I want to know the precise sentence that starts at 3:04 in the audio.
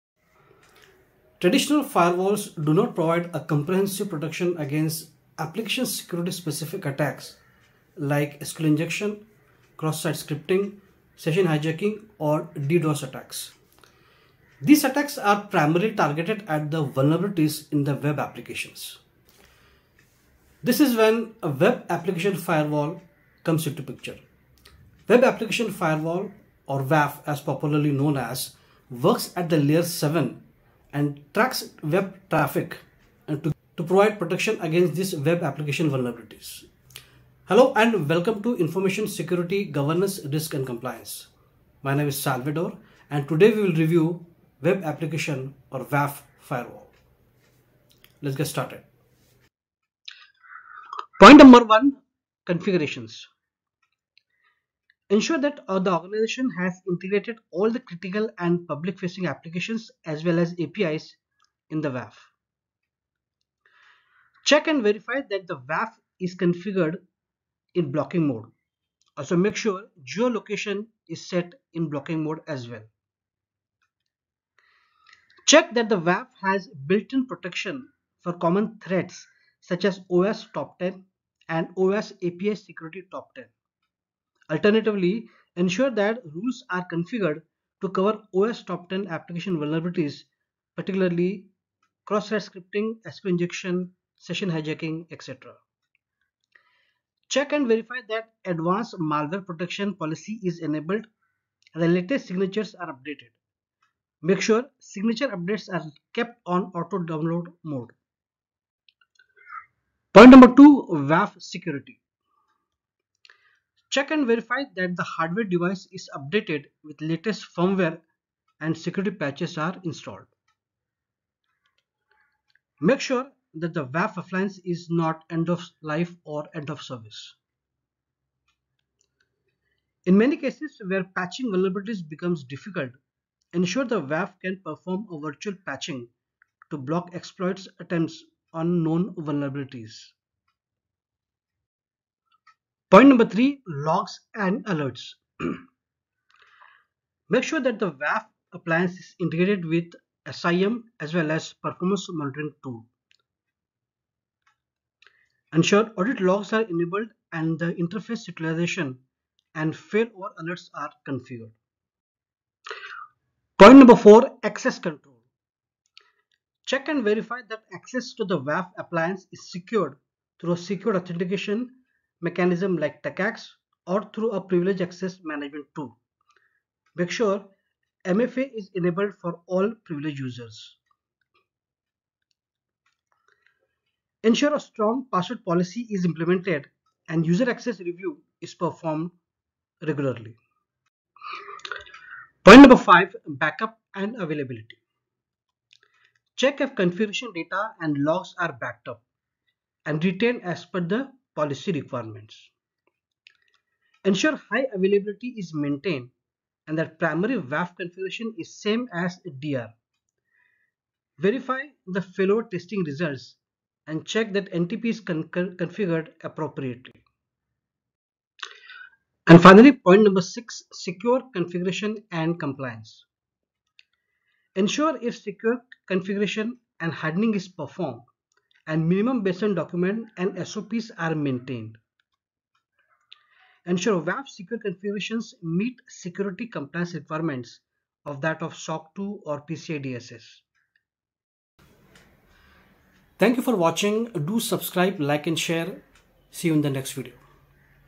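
Ensure a strong password policy is implemented and user access review is performed regularly.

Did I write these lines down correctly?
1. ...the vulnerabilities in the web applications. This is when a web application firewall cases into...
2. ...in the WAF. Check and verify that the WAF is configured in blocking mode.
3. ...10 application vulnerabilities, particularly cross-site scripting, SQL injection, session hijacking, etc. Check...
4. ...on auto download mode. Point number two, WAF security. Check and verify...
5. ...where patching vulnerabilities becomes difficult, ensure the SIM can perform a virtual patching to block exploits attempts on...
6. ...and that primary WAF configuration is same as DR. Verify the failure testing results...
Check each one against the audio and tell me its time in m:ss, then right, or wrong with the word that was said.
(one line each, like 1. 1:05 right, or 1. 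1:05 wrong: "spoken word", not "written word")
1. 0:16 wrong: "comes", not "cases"
2. 1:01 right
3. 1:28 right
4. 1:46 right
5. 2:10 wrong: "WAF", not "SIM"
6. 3:26 right.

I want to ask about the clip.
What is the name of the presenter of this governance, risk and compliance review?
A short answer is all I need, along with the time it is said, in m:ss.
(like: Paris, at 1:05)
Salvadore, at 0:42.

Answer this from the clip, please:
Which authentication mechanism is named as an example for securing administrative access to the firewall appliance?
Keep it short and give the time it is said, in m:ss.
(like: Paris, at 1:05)
TACACS, at 2:53.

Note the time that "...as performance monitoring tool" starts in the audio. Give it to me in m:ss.
2:31.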